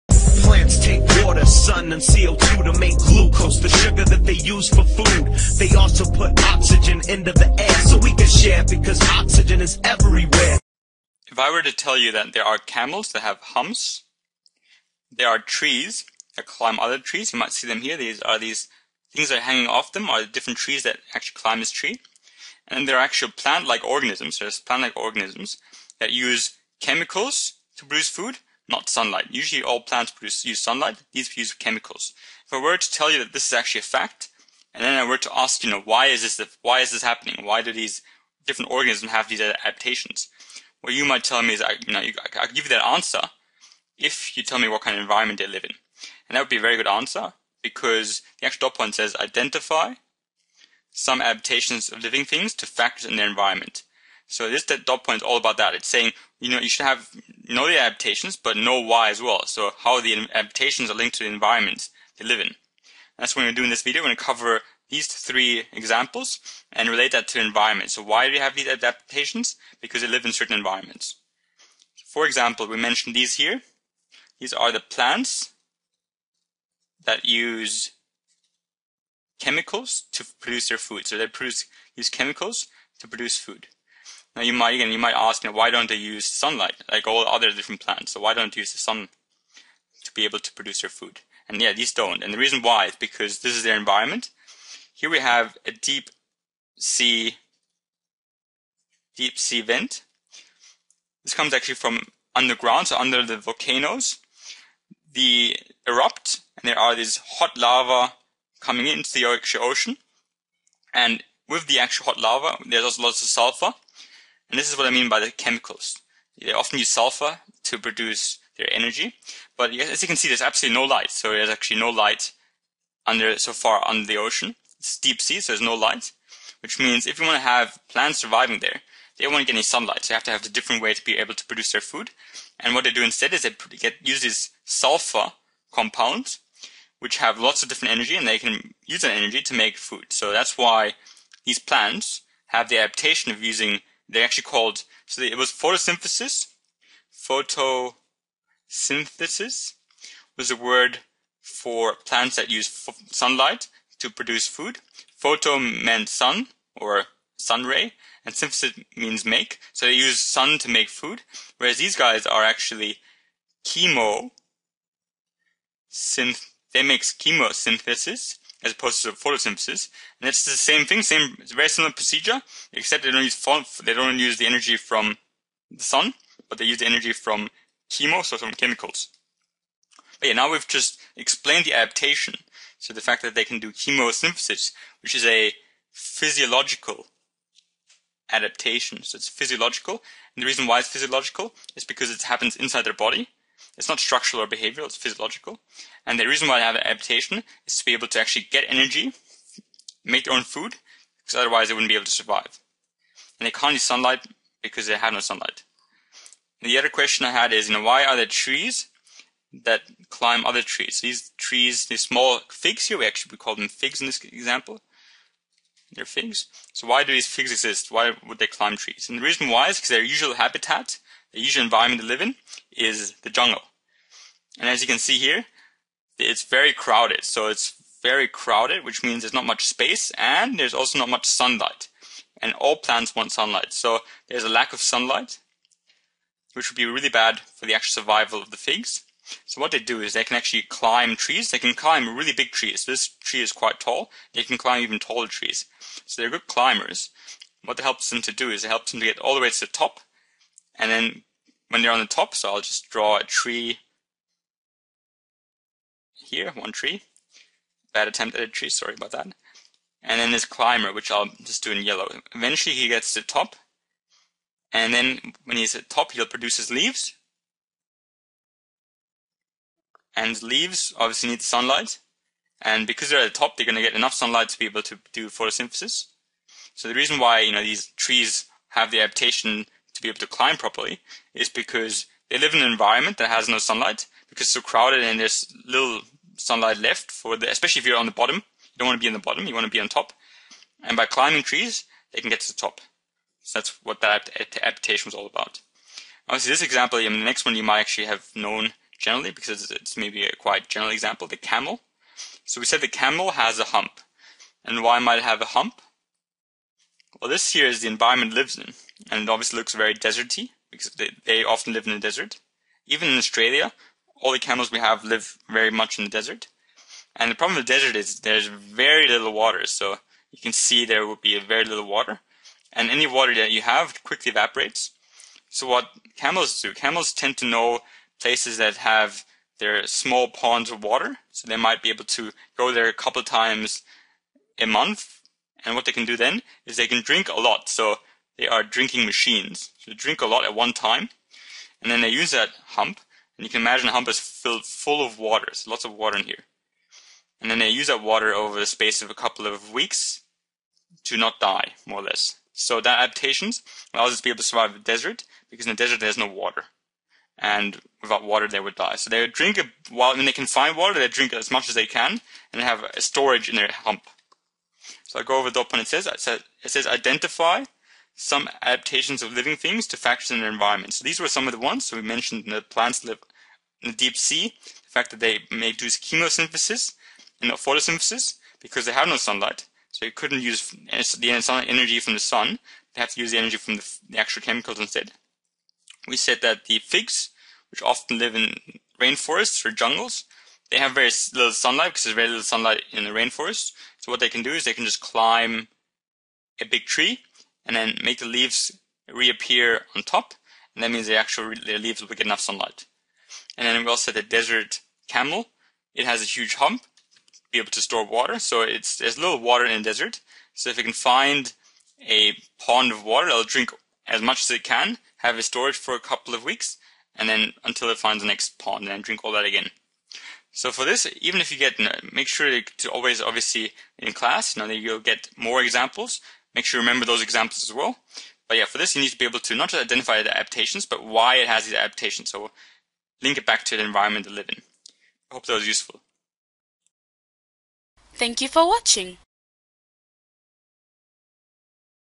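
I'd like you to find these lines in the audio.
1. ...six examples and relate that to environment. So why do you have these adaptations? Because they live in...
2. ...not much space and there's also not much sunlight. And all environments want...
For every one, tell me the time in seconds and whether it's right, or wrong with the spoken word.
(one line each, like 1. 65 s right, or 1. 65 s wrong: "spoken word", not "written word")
1. 65 s wrong: "three", not "six"
2. 229 s wrong: "plants", not "environments".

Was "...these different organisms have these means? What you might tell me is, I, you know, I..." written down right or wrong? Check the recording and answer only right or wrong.
wrong.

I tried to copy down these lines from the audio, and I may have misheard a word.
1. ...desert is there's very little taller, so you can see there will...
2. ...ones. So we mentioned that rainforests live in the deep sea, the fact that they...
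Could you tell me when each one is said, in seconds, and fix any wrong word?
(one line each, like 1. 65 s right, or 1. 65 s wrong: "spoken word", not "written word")
1. 317 s wrong: "water", not "taller"
2. 371 s wrong: "plants", not "rainforests".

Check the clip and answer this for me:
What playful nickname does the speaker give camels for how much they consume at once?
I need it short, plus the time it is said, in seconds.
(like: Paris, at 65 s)
Drinking machines, at 338 s.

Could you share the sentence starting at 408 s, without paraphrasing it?
So it's there's little water in the desert.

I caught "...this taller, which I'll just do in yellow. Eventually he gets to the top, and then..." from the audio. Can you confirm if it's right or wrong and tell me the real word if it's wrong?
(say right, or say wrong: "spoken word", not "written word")
wrong: "climber", not "taller".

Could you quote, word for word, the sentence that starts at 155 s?
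Photo meant sun or sun ray, and synthesis means make.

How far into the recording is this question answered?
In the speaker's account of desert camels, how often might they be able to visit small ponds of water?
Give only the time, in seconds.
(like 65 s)
332 s.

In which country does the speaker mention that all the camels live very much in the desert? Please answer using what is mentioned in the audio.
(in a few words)
Australia.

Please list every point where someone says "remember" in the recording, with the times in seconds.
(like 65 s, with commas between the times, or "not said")
426 s.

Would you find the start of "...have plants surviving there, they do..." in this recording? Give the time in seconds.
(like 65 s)
127 s.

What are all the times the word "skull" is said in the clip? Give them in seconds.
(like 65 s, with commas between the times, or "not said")
not said.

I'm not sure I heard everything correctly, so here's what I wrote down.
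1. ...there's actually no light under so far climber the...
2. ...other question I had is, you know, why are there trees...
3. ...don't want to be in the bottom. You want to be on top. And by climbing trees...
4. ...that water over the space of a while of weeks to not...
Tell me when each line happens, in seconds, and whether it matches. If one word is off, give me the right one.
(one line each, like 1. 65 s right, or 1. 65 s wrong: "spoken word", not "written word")
1. 121 s wrong: "under", not "climber"
2. 206 s right
3. 288 s right
4. 347 s wrong: "couple", not "while".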